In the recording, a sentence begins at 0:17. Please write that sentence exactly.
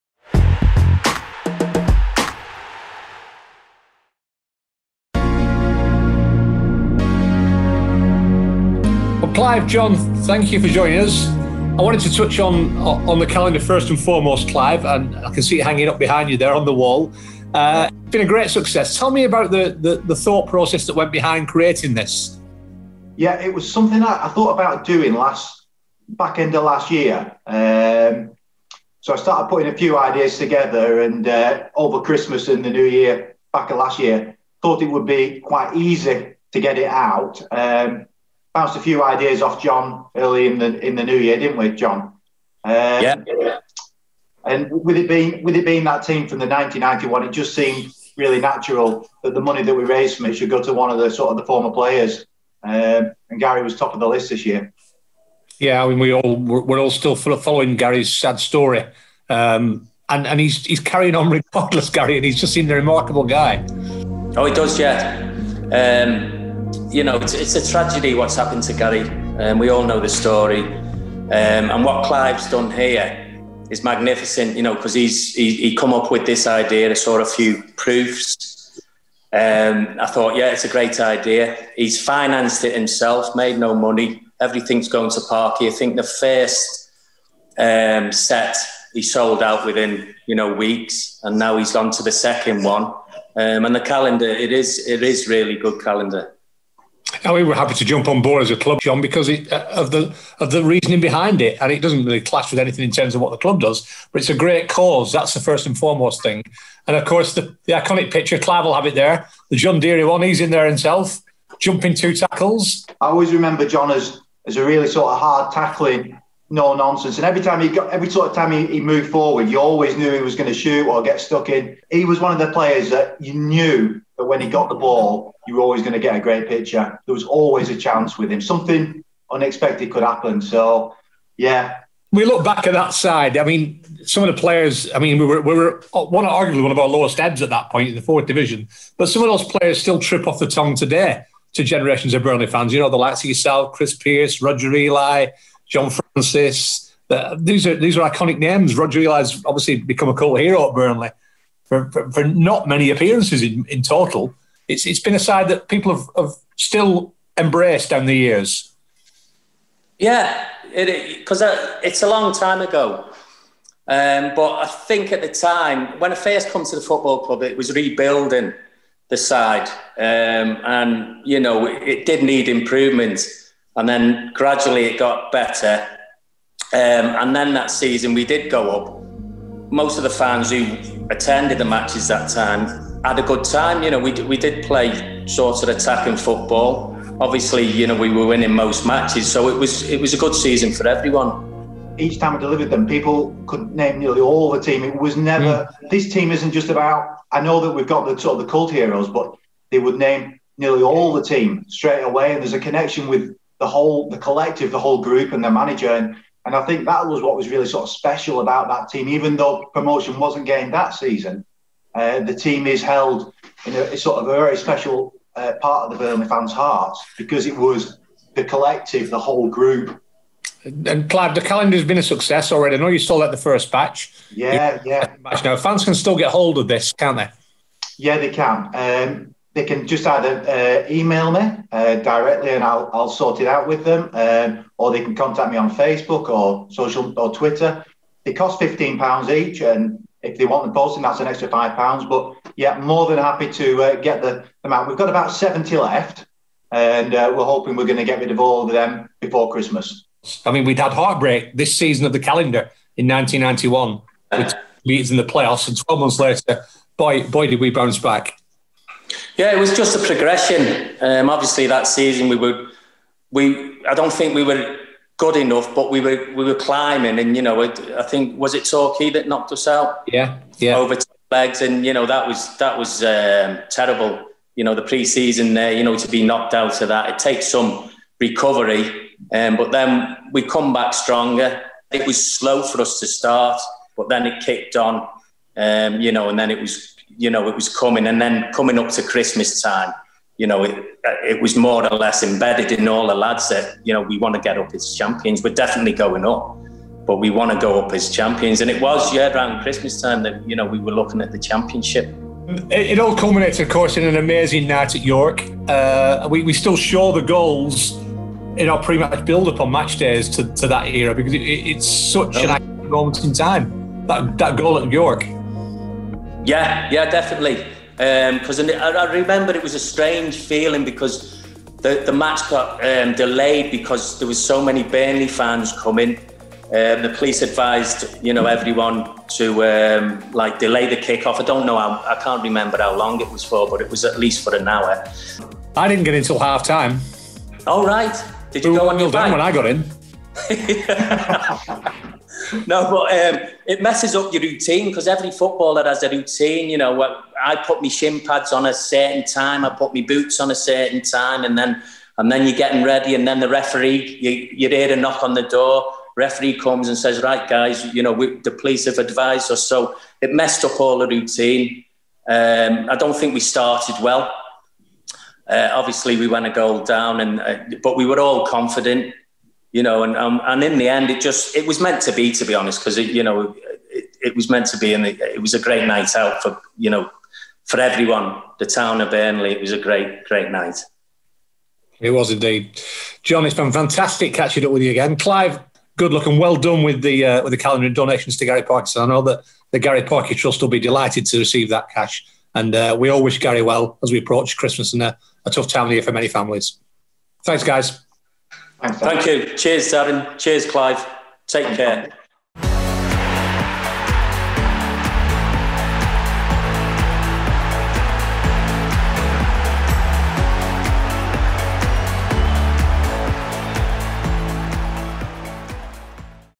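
Uh, it's been a great success.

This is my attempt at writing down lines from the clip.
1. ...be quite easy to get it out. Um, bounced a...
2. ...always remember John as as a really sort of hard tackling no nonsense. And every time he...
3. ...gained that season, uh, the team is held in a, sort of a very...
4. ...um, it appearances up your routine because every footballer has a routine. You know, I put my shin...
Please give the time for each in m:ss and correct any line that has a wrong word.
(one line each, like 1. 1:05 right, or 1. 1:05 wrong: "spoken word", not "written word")
1. 0:35 right
2. 1:53 right
3. 3:30 right
4. 5:43 wrong: "messes", not "appearances".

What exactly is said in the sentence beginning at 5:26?
Um, the police advised, you know, everyone to um, like delay the kickoff.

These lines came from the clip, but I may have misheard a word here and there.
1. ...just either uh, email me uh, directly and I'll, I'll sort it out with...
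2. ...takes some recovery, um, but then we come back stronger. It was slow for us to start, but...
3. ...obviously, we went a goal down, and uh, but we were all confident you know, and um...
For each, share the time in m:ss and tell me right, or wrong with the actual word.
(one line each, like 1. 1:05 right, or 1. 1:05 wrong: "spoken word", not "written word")
1. 3:49 right
2. 4:37 right
3. 6:05 right.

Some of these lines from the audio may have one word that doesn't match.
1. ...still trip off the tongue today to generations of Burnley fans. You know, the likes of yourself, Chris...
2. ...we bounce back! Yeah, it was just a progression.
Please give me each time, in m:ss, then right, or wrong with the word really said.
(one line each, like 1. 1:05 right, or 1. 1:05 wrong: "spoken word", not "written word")
1. 2:19 right
2. 4:17 right.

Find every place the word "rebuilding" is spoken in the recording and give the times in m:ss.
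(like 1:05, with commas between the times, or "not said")
2:47.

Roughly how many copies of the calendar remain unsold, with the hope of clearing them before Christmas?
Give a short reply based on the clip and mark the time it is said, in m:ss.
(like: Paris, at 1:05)
70, at 4:05.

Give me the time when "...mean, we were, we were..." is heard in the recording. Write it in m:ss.
2:14.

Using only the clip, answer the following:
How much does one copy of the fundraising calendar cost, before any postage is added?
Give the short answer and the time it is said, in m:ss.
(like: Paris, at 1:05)
15 pounds, at 3:58.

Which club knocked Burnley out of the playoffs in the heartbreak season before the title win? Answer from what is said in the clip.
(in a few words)
Torquay.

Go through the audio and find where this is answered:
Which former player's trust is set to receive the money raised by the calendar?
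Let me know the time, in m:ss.
6:28.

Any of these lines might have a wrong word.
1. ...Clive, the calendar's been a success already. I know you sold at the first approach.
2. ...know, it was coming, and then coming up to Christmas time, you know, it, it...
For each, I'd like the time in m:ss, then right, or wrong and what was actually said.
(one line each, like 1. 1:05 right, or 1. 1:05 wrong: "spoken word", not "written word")
1. 3:41 wrong: "batch", not "approach"
2. 4:47 right.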